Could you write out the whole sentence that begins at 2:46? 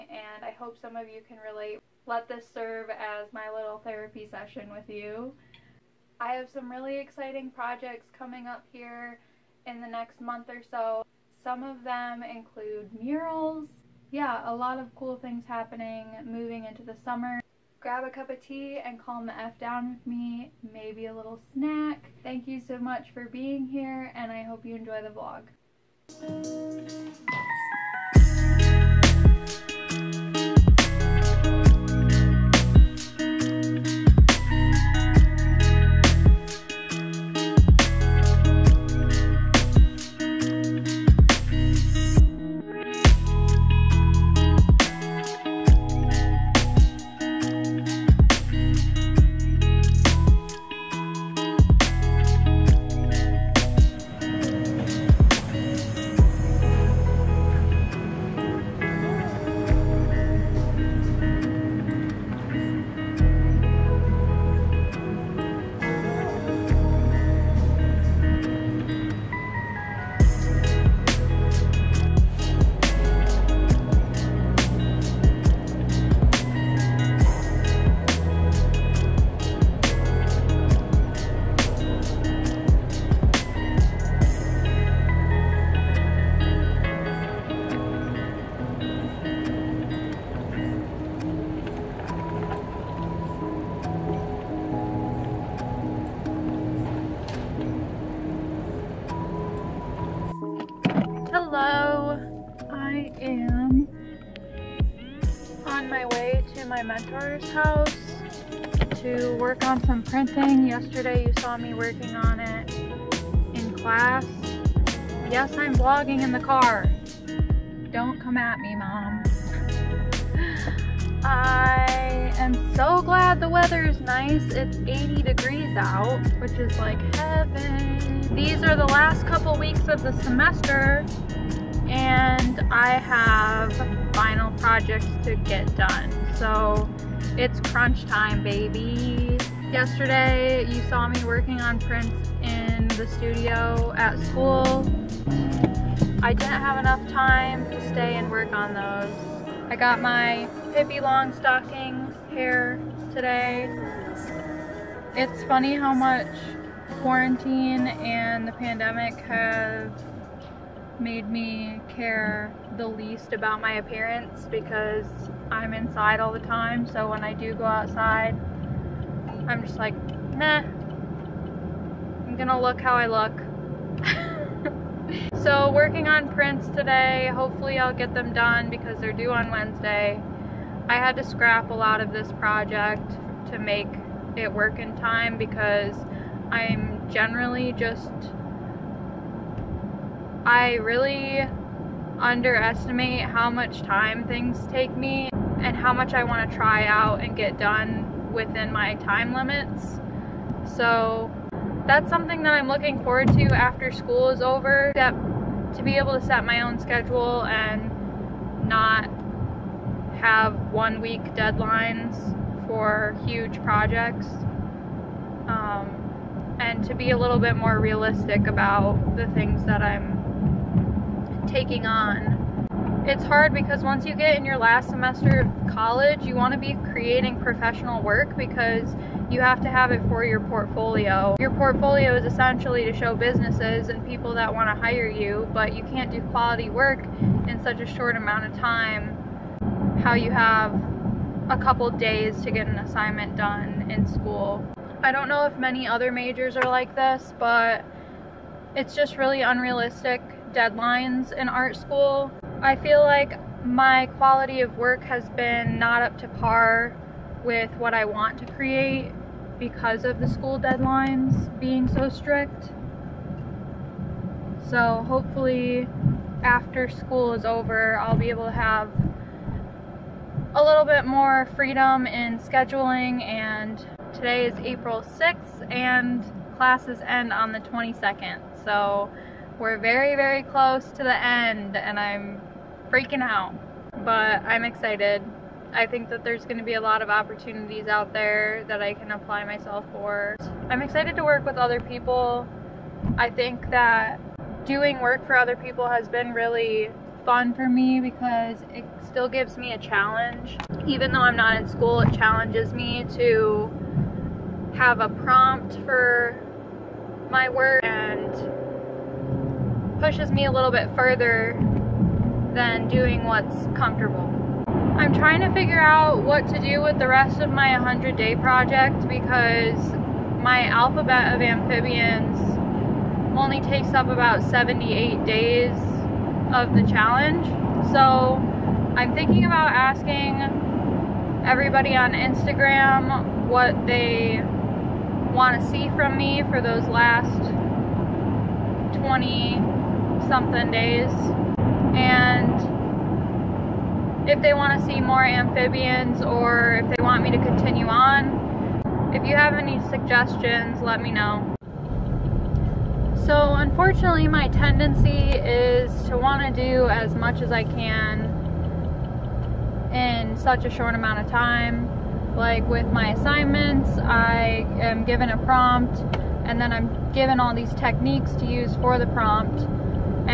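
So when I do go outside, I'm just like, meh, I'm gonna look how I look.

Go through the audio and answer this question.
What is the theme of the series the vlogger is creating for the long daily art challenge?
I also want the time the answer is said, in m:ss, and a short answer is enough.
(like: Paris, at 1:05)
alphabet of amphibians, at 5:20.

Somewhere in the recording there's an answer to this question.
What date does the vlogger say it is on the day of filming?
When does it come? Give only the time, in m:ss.
4:34.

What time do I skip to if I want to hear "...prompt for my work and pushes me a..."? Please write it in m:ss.
5:05.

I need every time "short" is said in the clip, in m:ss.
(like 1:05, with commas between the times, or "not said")
3:57, 6:00.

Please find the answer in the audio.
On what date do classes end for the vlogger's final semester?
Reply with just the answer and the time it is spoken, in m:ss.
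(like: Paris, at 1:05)
the 22nd, at 4:37.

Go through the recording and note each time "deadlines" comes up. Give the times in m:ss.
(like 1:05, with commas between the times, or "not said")
3:31, 4:10, 4:20.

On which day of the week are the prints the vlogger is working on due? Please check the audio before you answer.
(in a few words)
Wednesday.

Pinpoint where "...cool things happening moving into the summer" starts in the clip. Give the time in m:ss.
0:14.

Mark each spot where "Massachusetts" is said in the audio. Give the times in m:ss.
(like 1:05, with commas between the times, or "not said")
not said.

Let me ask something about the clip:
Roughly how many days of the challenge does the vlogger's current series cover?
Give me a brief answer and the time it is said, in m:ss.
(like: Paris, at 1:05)
78, at 5:24.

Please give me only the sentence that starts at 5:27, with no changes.
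So I'm thinking about asking everybody on Instagram what they want to see from me for those last 20 something days.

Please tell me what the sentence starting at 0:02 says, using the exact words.
Let this serve as my little therapy session with you.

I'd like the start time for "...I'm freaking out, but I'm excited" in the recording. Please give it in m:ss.
4:41.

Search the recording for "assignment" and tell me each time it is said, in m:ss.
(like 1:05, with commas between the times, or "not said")
4:02, 6:03.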